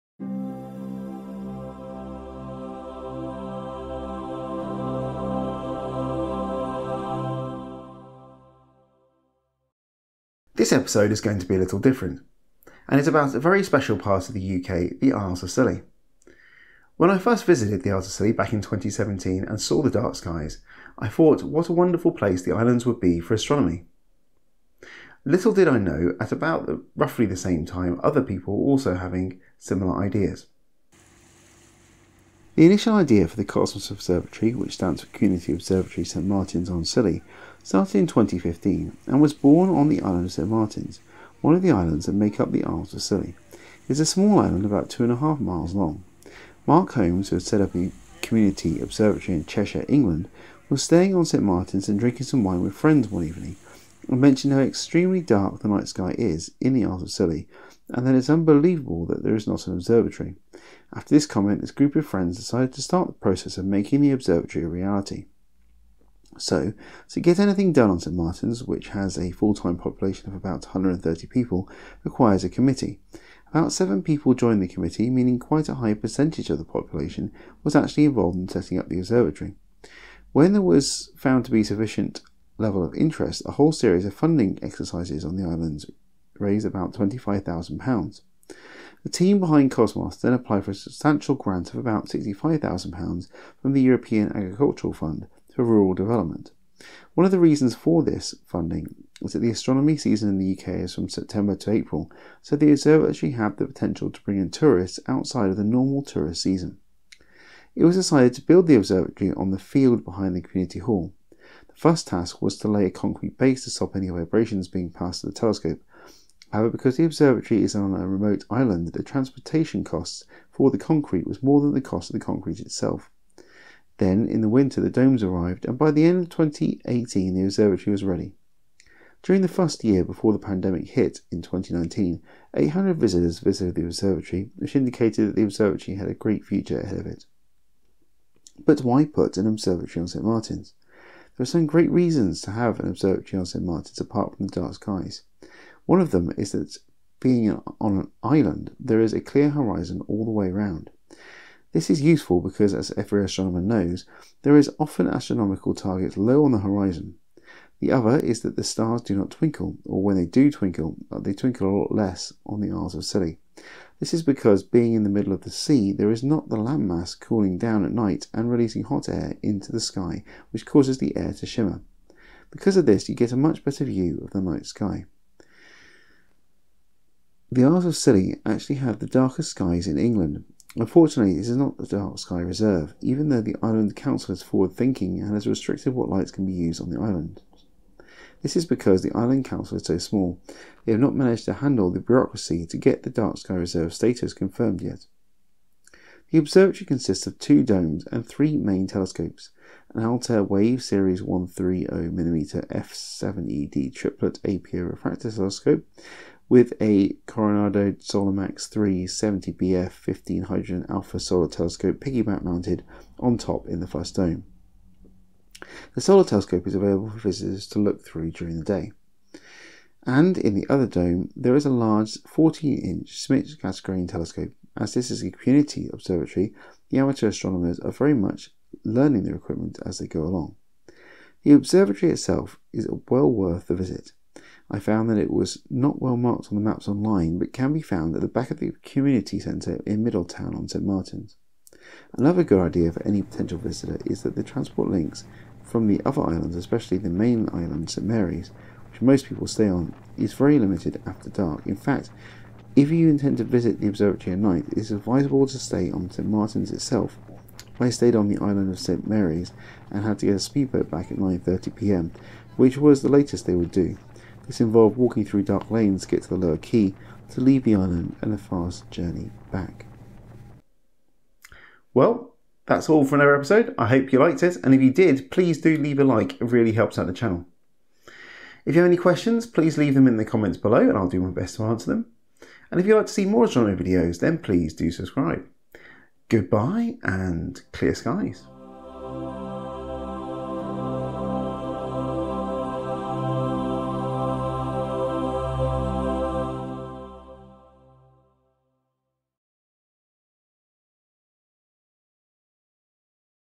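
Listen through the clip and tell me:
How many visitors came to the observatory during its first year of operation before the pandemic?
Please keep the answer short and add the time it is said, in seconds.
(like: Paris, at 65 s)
800, at 132 s.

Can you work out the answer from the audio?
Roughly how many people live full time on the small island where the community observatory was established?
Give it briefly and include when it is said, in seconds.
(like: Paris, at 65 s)
130, at 70 s.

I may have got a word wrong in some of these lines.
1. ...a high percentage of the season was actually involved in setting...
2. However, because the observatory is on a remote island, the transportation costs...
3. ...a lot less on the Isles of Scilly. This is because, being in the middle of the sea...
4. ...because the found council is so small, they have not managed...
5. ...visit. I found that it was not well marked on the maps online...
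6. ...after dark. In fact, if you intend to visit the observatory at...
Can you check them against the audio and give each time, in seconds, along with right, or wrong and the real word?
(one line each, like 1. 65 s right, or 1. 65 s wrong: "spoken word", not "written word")
1. 75 s wrong: "population", not "season"
2. 116 s right
3. 161 s right
4. 188 s wrong: "island", not "found"
5. 233 s right
6. 251 s right.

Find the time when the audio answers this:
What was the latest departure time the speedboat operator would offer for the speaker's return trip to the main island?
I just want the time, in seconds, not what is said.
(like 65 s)
261 s.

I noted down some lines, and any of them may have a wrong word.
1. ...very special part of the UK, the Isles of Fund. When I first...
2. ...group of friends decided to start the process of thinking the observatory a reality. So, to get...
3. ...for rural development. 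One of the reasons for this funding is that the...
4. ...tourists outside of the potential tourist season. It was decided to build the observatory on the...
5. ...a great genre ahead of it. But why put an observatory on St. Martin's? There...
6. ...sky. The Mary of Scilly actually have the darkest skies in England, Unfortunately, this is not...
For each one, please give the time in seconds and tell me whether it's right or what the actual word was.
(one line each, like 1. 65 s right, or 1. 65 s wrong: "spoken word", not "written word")
1. 13 s wrong: "Scilly", not "Fund"
2. 61 s wrong: "making", not "thinking"
3. 95 s right
4. 104 s wrong: "normal", not "potential"
5. 136 s wrong: "future", not "genre"
6. 174 s wrong: "Isles", not "Mary".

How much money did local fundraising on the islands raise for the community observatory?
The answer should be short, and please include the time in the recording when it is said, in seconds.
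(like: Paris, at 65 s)
£25,000, at 86 s.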